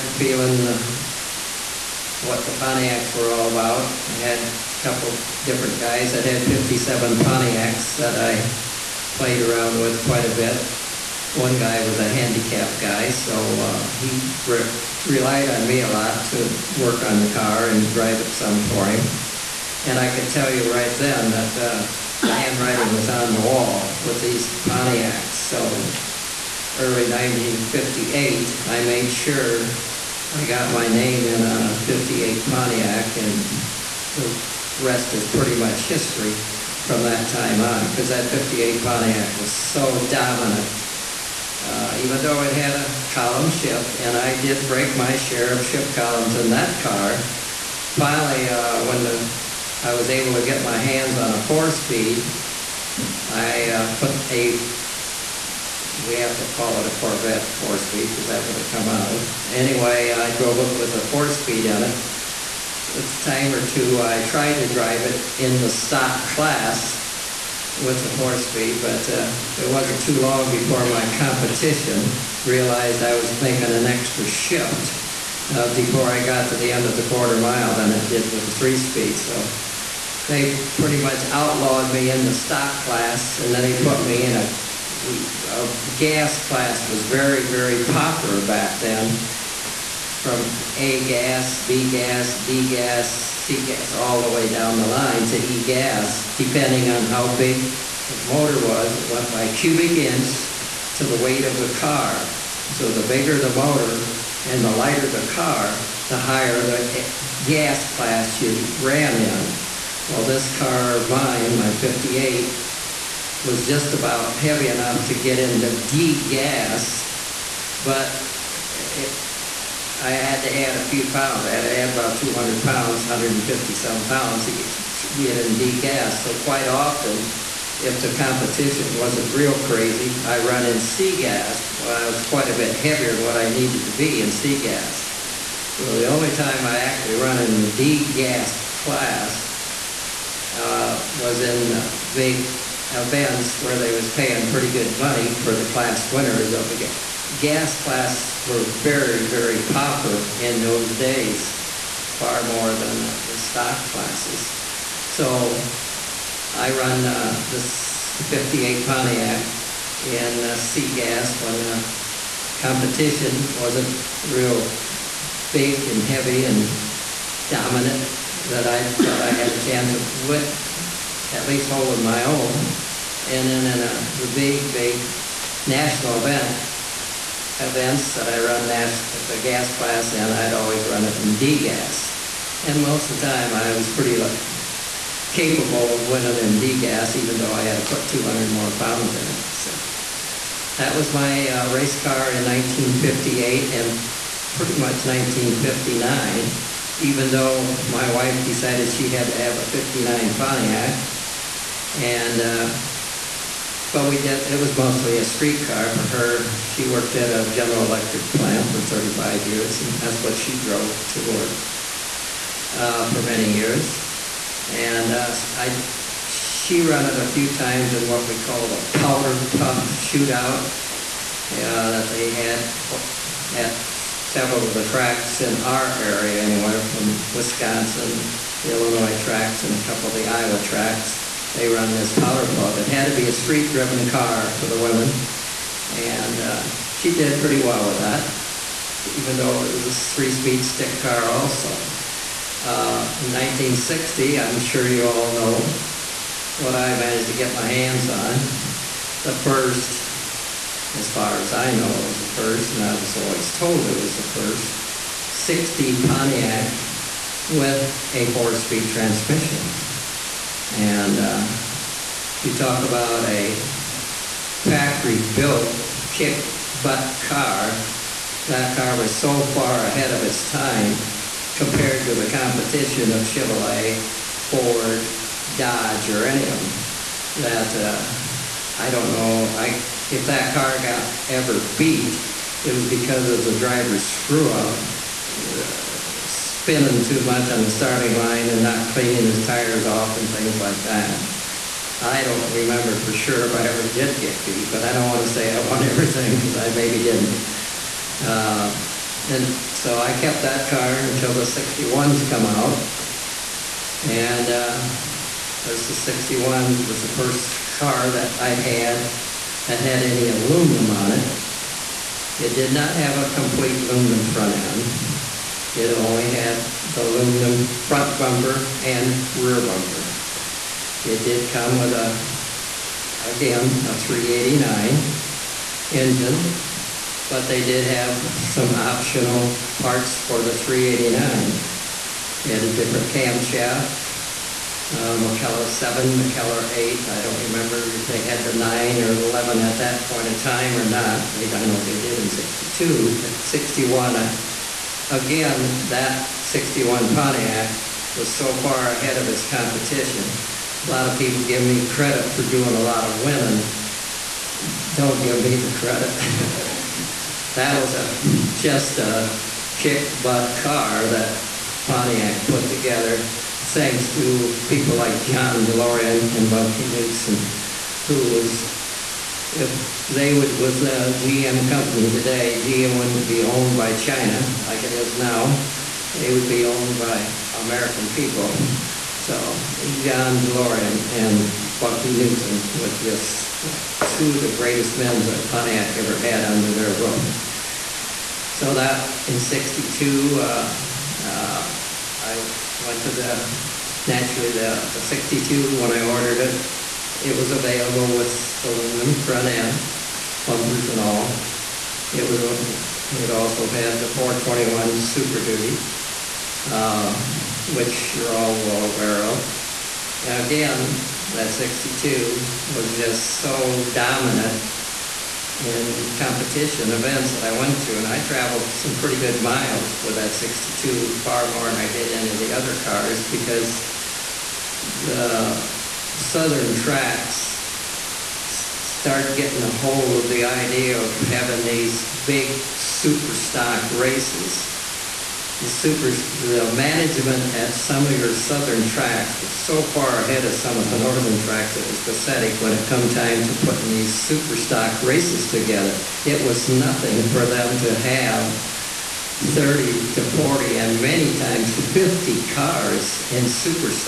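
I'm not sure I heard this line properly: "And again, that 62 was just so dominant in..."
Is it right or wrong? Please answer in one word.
right.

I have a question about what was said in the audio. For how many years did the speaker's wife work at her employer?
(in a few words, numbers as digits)
35 years.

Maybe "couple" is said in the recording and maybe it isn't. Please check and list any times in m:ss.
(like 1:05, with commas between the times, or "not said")
0:04, 3:49.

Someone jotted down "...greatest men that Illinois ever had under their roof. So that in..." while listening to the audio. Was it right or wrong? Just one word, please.
wrong.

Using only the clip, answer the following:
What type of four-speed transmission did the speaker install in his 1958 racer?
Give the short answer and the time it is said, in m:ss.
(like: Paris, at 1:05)
Corvette four speed, at 0:56.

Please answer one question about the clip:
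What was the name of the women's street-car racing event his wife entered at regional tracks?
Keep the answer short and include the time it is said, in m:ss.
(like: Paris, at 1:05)
powder puff shootout, at 3:38.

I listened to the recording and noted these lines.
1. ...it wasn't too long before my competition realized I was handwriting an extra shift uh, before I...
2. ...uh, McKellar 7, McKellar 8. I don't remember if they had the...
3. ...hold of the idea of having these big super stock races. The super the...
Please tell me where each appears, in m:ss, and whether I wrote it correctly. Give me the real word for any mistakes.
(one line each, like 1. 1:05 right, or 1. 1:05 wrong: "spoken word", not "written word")
1. 1:09 wrong: "making", not "handwriting"
2. 5:34 right
3. 7:09 right.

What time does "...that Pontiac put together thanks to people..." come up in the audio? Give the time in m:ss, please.
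6:01.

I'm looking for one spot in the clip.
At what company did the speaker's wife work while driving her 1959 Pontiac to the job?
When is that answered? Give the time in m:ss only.
3:27.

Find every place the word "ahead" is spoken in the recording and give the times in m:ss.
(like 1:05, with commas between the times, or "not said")
4:29, 5:48, 7:20.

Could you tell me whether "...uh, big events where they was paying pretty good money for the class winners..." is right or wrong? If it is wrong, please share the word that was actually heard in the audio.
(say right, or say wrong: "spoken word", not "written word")
right.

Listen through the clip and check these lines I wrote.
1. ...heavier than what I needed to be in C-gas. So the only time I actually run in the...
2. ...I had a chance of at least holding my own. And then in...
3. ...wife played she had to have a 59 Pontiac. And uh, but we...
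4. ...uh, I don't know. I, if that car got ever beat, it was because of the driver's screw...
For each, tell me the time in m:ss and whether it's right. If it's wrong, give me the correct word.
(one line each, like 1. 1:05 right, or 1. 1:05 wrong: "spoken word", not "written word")
1. 2:12 right
2. 2:49 right
3. 3:18 wrong: "decided", not "played"
4. 4:37 right.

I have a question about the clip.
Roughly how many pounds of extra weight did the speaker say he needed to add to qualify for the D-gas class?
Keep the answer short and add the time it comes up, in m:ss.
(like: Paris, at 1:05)
200 pounds, at 2:02.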